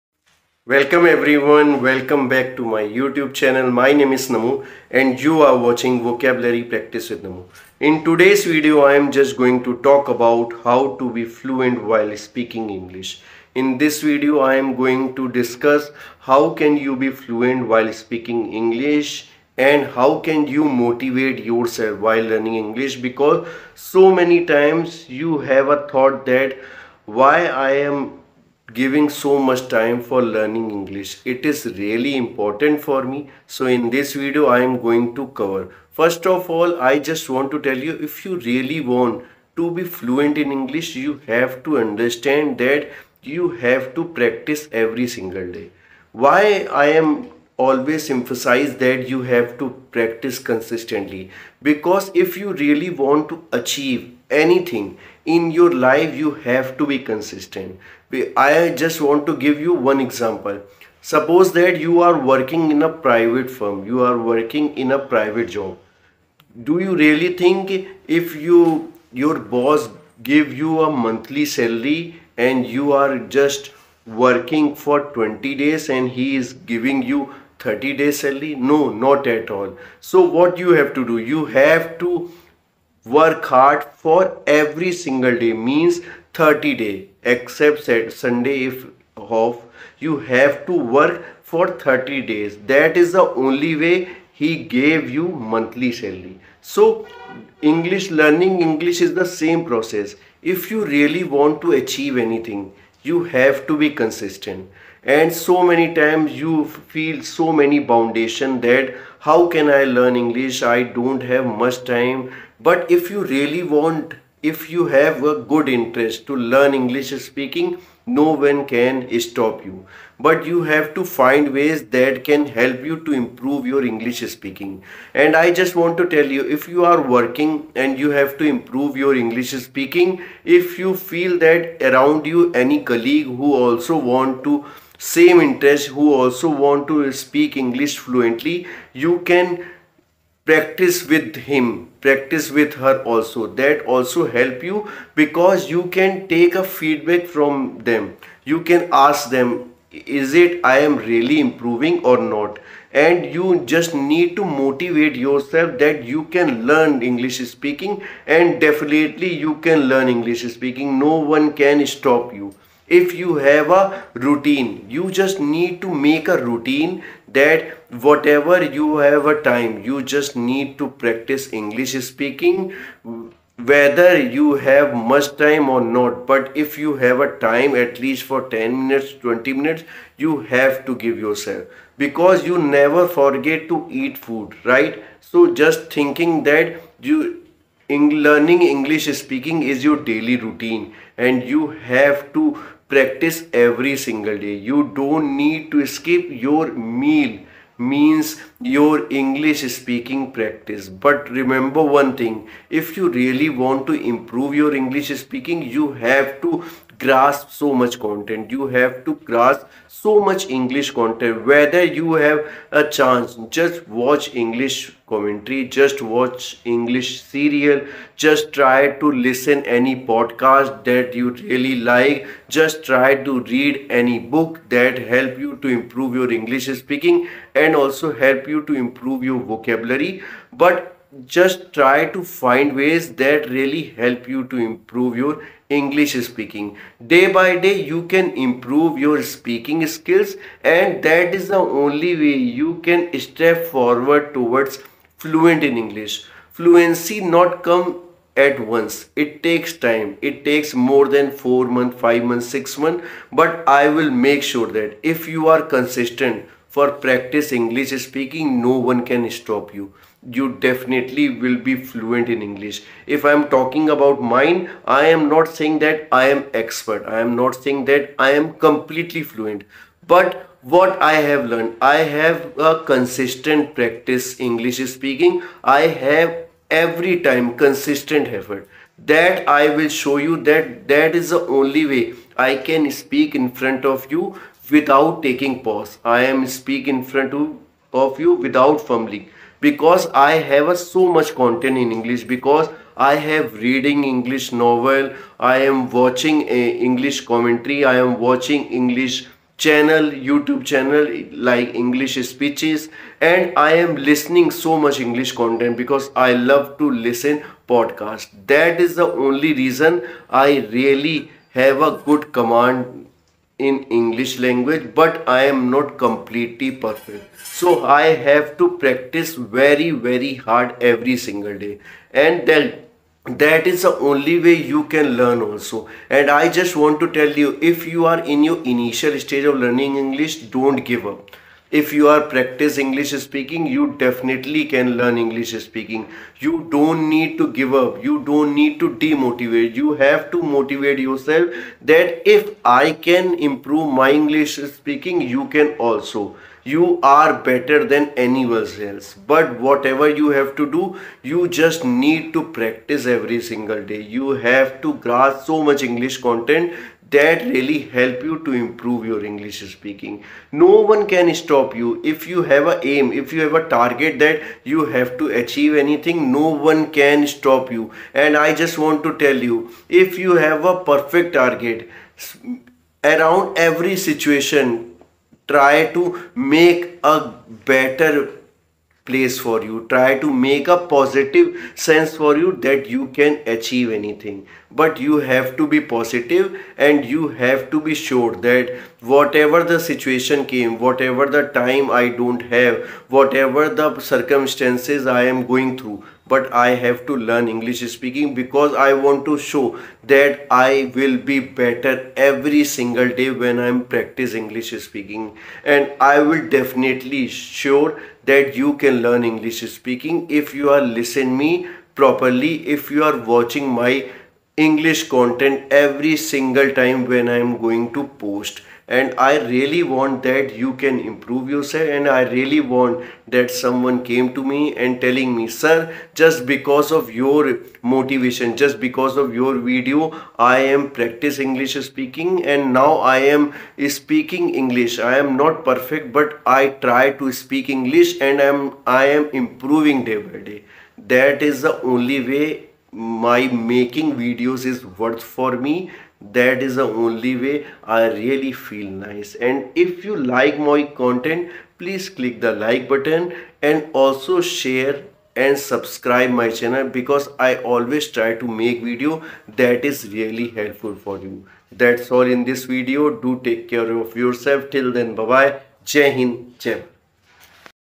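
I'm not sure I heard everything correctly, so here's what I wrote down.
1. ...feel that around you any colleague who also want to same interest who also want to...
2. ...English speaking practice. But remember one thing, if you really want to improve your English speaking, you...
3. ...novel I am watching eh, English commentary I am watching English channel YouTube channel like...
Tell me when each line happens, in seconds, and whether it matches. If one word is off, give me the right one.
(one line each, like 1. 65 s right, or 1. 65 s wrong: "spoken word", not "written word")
1. 130 s right
2. 199 s right
3. 294 s right.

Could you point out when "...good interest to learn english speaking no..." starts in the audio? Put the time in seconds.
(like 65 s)
115 s.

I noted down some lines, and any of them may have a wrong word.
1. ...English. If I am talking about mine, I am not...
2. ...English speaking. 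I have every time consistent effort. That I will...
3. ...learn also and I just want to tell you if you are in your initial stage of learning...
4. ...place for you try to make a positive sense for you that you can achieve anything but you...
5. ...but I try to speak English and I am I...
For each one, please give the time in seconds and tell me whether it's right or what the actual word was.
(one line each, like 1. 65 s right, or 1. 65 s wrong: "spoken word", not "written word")
1. 262 s right
2. 274 s right
3. 325 s right
4. 379 s right
5. 436 s right.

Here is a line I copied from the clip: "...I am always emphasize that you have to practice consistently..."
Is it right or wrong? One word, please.
right.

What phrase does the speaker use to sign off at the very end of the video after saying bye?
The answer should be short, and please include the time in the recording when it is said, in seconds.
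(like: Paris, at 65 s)
jai hind, at 465 s.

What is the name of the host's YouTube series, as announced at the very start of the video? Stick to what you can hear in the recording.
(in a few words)
Vocabulary Practice with Namo.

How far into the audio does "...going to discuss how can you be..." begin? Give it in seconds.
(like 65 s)
14 s.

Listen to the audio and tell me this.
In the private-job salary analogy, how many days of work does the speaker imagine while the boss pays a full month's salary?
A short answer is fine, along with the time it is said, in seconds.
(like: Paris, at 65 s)
20, at 75 s.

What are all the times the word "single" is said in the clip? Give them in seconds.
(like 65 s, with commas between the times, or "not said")
45 s, 85 s, 193 s, 321 s, 353 s, 402 s, 416 s.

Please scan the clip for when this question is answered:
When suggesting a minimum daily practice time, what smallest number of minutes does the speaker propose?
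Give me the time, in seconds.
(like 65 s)
178 s.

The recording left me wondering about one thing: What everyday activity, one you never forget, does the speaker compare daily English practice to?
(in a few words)
eat food.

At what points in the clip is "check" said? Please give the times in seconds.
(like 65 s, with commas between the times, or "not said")
not said.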